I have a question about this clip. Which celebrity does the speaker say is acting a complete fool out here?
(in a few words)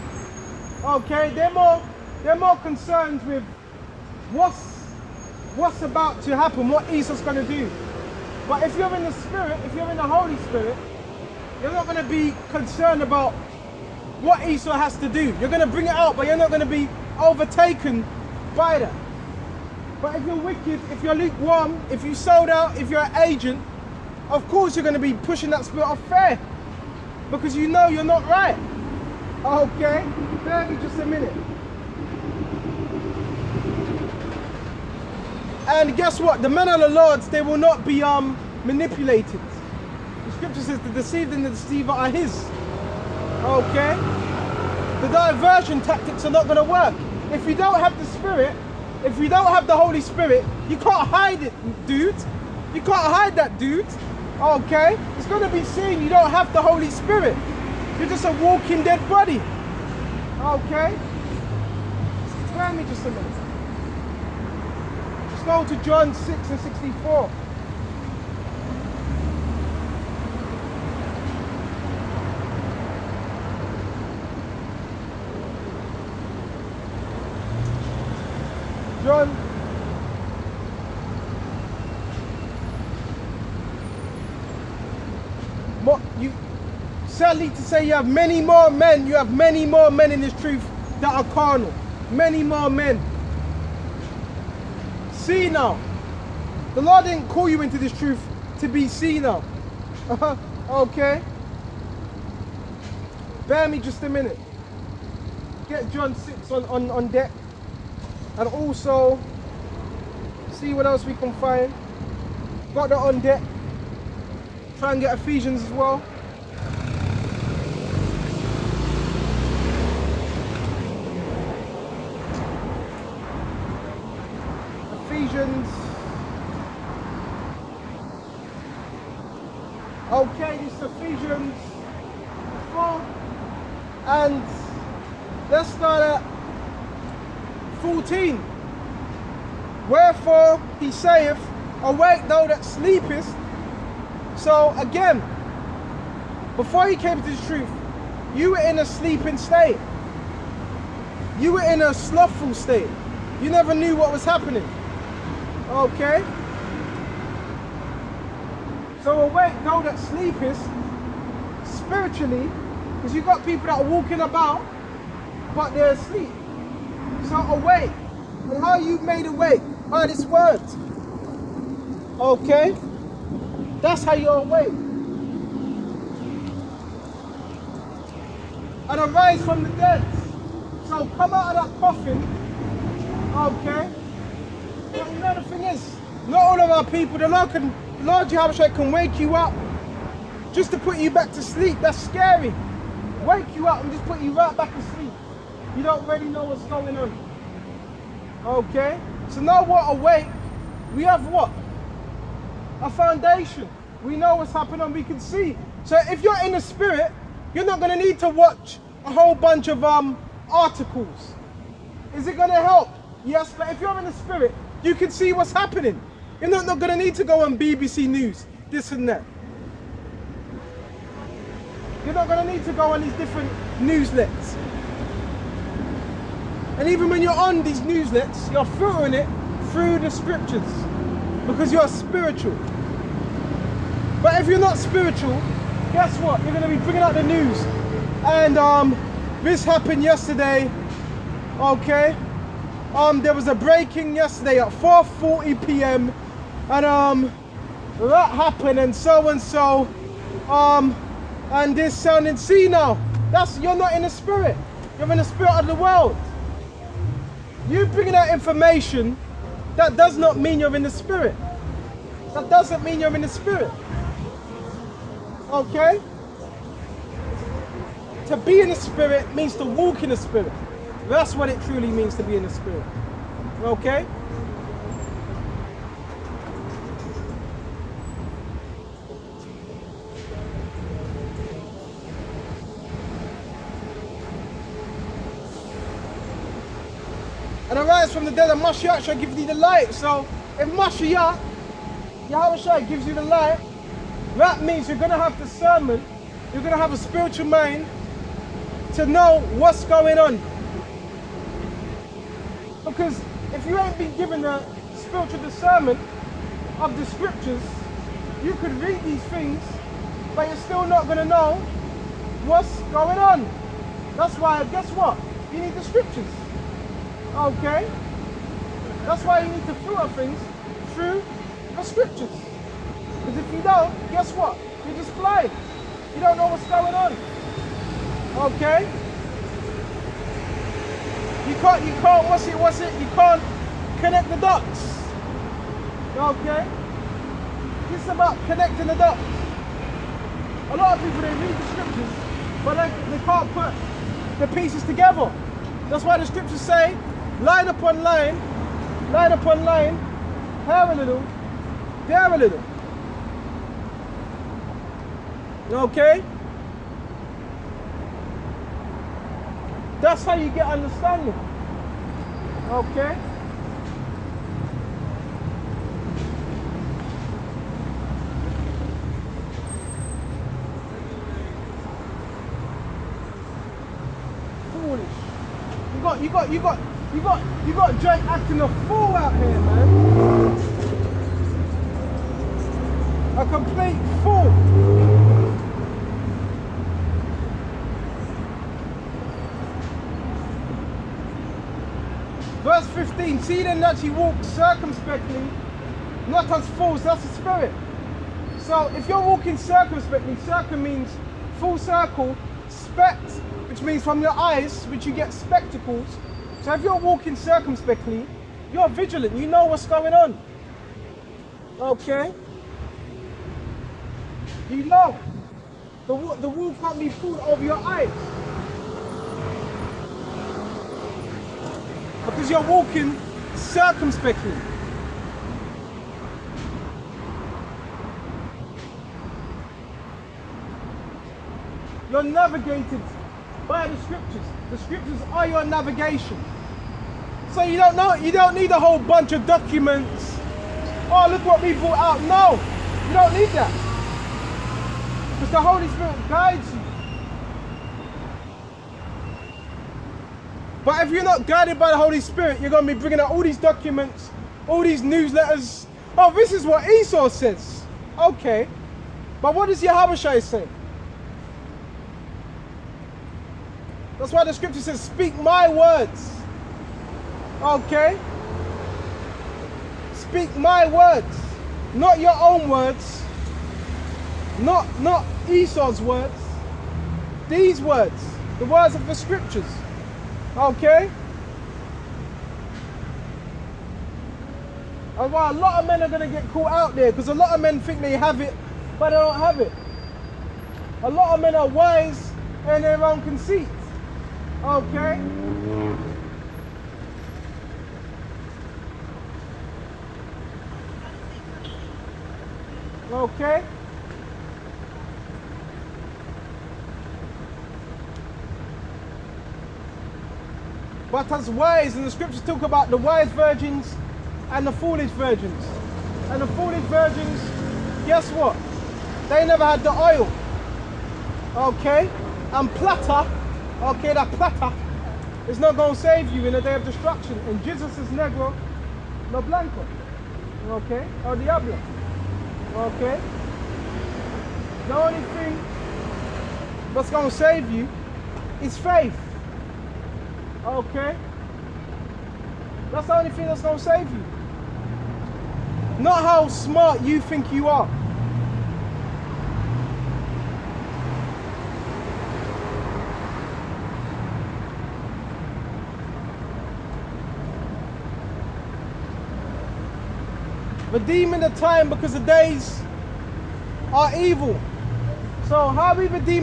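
Drake.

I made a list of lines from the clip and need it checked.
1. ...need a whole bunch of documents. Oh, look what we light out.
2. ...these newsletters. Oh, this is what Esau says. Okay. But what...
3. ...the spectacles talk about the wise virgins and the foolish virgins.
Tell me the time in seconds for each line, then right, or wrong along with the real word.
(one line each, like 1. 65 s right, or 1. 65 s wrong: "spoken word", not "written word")
1. 438 s wrong: "brought", not "light"
2. 454 s right
3. 512 s wrong: "scriptures", not "spectacles".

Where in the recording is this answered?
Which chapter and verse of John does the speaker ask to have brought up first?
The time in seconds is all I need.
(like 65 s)
65 s.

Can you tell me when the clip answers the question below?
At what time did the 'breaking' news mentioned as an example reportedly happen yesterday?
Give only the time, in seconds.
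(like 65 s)
244 s.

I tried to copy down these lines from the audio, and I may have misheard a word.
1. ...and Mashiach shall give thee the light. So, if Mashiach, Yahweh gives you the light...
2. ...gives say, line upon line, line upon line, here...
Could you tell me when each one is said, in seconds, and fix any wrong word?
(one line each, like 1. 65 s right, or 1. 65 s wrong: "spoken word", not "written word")
1. 288 s right
2. 346 s wrong: "scriptures", not "gives".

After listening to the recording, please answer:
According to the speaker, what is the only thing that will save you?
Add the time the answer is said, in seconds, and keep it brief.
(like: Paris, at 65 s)
faith, at 538 s.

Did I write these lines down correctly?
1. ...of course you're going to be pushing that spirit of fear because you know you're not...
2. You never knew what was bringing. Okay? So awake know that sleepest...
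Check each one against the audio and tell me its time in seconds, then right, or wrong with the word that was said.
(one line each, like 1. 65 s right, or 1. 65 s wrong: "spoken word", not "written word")
1. 24 s right
2. 153 s wrong: "happening", not "bringing".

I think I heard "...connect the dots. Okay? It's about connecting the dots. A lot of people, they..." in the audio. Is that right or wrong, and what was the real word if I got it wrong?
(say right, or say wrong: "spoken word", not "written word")
right.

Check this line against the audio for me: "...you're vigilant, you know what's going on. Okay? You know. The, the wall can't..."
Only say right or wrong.
right.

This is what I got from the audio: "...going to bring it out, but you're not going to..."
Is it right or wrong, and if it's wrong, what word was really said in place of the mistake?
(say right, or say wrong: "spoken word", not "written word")
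right.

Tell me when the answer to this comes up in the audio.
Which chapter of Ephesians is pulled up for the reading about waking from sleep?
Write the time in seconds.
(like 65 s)
130 s.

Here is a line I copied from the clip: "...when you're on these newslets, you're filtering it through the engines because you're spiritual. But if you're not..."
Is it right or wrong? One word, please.
wrong.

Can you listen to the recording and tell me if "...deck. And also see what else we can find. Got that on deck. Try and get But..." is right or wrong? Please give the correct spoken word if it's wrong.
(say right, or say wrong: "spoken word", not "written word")
wrong: "Ephesians", not "But".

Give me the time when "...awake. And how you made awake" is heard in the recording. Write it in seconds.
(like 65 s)
167 s.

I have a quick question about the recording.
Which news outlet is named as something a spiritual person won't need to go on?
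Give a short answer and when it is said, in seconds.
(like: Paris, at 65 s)
BBC News, at 217 s.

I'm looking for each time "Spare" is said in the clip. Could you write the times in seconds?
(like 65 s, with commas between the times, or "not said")
62 s.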